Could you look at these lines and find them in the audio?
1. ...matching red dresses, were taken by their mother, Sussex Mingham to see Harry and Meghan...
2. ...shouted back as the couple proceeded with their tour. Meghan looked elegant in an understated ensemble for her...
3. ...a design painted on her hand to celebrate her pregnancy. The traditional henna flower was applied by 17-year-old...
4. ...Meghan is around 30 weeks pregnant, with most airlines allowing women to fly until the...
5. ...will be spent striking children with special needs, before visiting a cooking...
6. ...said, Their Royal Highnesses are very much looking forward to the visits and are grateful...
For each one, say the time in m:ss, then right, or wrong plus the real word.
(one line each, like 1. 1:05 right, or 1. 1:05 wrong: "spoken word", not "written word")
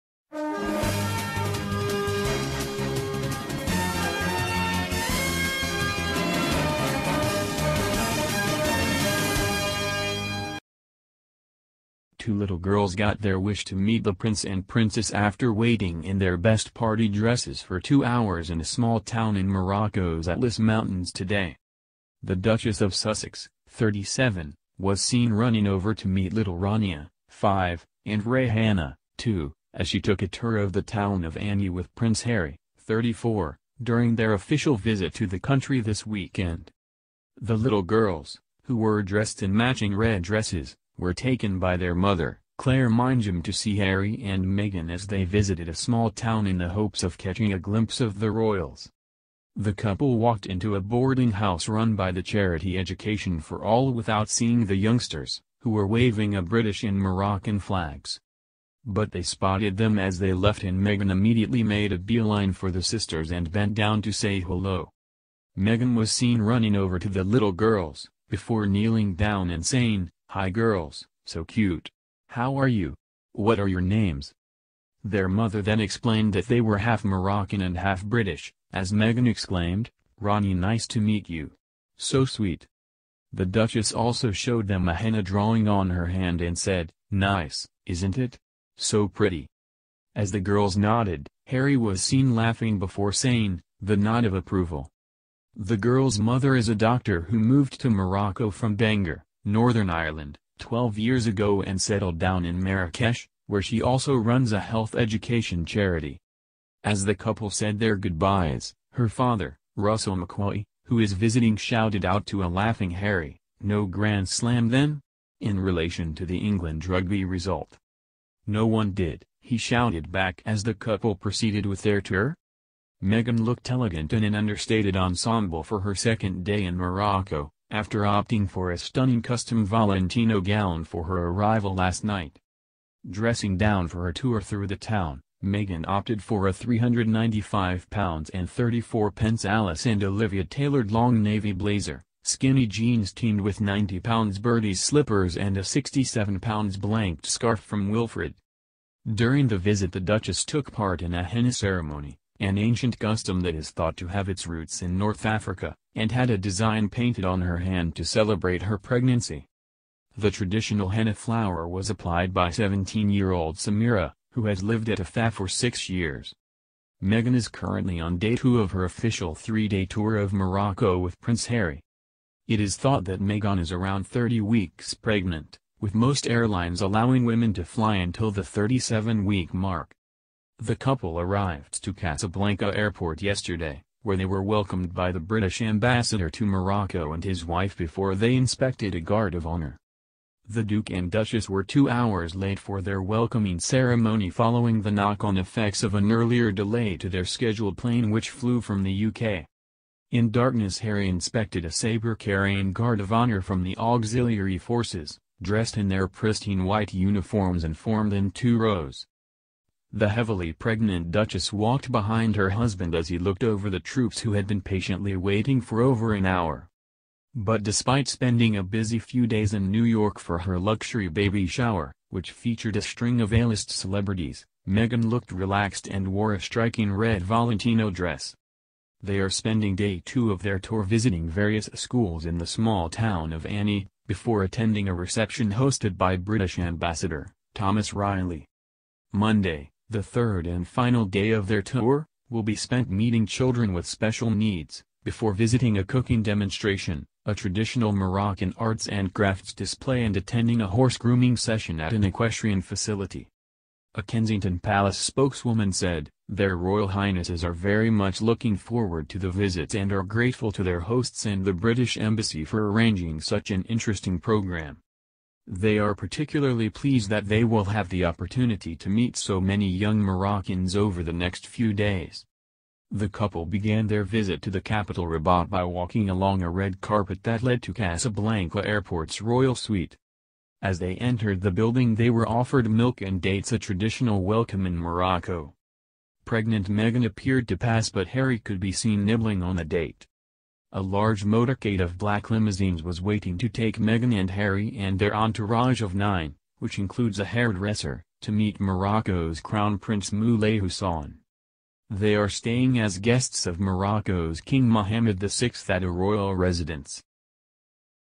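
1. 0:39 wrong: "Claire", not "Sussex"
2. 1:59 right
3. 2:36 right
4. 2:53 right
5. 4:02 wrong: "meeting", not "striking"
6. 4:15 right.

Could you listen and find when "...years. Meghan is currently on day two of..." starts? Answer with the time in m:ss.
2:45.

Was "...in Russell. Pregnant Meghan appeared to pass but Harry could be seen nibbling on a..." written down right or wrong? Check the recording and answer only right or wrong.
wrong.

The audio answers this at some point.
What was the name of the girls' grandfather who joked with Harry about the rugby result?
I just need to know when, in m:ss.
1:49.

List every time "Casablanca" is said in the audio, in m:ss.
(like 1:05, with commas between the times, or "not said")
3:01, 4:37.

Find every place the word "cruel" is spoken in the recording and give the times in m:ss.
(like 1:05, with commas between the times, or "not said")
not said.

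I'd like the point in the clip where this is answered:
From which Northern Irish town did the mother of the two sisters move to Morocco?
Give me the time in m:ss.
1:38.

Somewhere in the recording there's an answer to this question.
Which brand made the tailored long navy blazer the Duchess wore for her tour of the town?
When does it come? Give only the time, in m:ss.
2:19.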